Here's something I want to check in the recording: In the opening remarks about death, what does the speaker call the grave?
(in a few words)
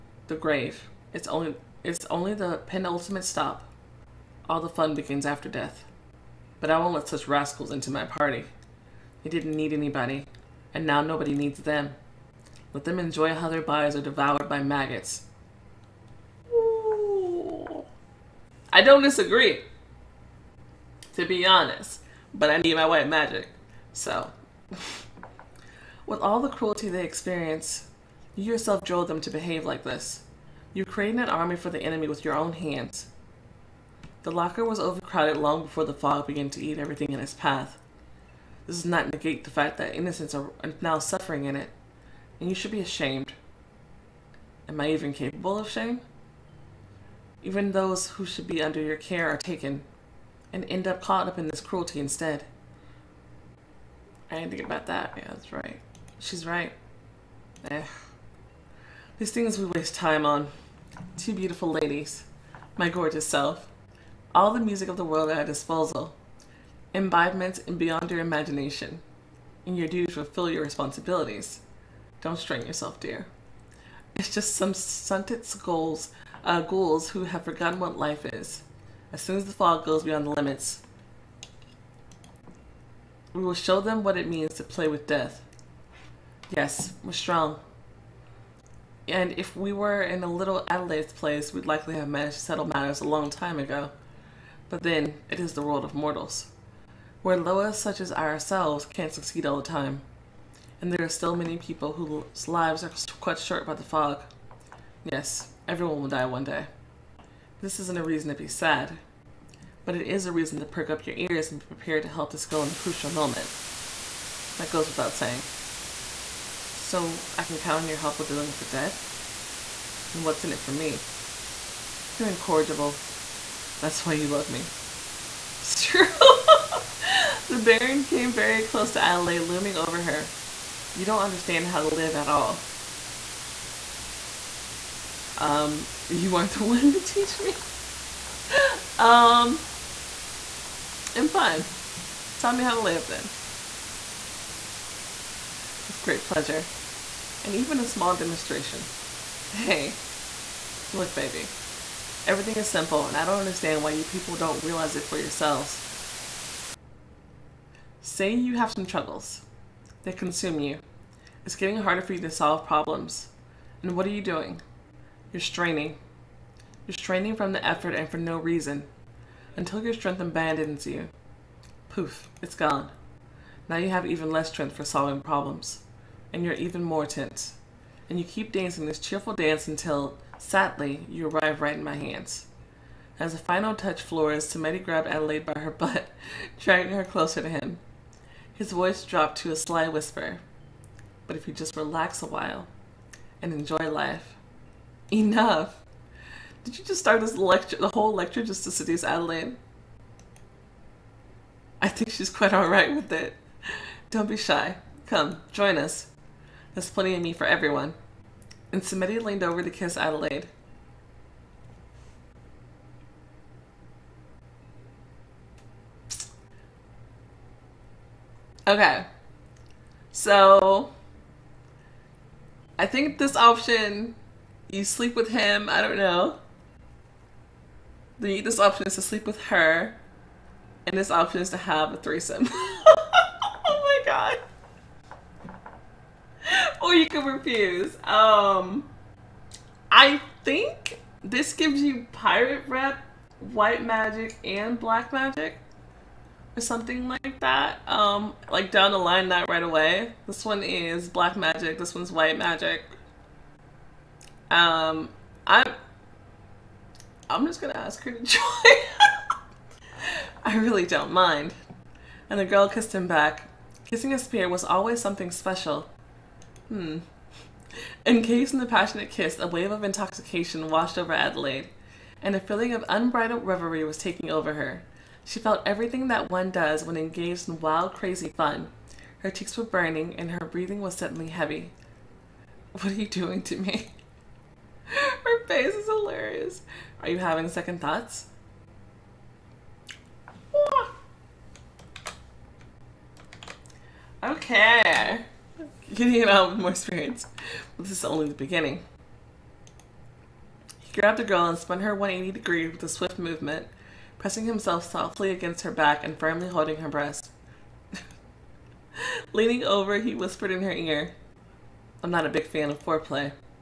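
The penultimate stop.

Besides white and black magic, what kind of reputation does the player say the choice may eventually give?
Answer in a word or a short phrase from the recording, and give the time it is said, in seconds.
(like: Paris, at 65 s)
Pirate rep, at 242 s.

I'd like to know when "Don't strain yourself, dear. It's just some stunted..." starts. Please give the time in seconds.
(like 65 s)
72 s.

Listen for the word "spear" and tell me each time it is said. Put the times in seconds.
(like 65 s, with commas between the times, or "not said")
264 s.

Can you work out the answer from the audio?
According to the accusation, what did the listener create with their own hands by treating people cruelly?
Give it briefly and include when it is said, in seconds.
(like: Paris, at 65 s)
An army for the enemy, at 31 s.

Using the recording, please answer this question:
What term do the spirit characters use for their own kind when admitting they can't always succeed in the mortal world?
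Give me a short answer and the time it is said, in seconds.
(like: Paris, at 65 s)
Loas, at 97 s.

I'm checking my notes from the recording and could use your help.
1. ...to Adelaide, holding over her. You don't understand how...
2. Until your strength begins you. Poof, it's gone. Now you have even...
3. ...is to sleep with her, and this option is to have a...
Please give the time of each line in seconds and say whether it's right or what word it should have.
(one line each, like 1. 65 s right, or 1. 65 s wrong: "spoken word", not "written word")
1. 128 s wrong: "looming", not "holding"
2. 169 s wrong: "abandons", not "begins"
3. 228 s right.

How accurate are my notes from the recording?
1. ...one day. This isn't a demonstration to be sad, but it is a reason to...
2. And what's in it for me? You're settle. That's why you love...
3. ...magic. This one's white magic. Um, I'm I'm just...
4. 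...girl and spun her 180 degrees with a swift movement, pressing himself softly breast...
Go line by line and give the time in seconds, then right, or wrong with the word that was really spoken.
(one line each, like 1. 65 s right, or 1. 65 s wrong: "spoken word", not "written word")
1. 106 s wrong: "reason", not "demonstration"
2. 120 s wrong: "incorrigible", not "settle"
3. 251 s right
4. 301 s wrong: "against", not "breast".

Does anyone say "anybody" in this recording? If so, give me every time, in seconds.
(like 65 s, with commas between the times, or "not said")
9 s.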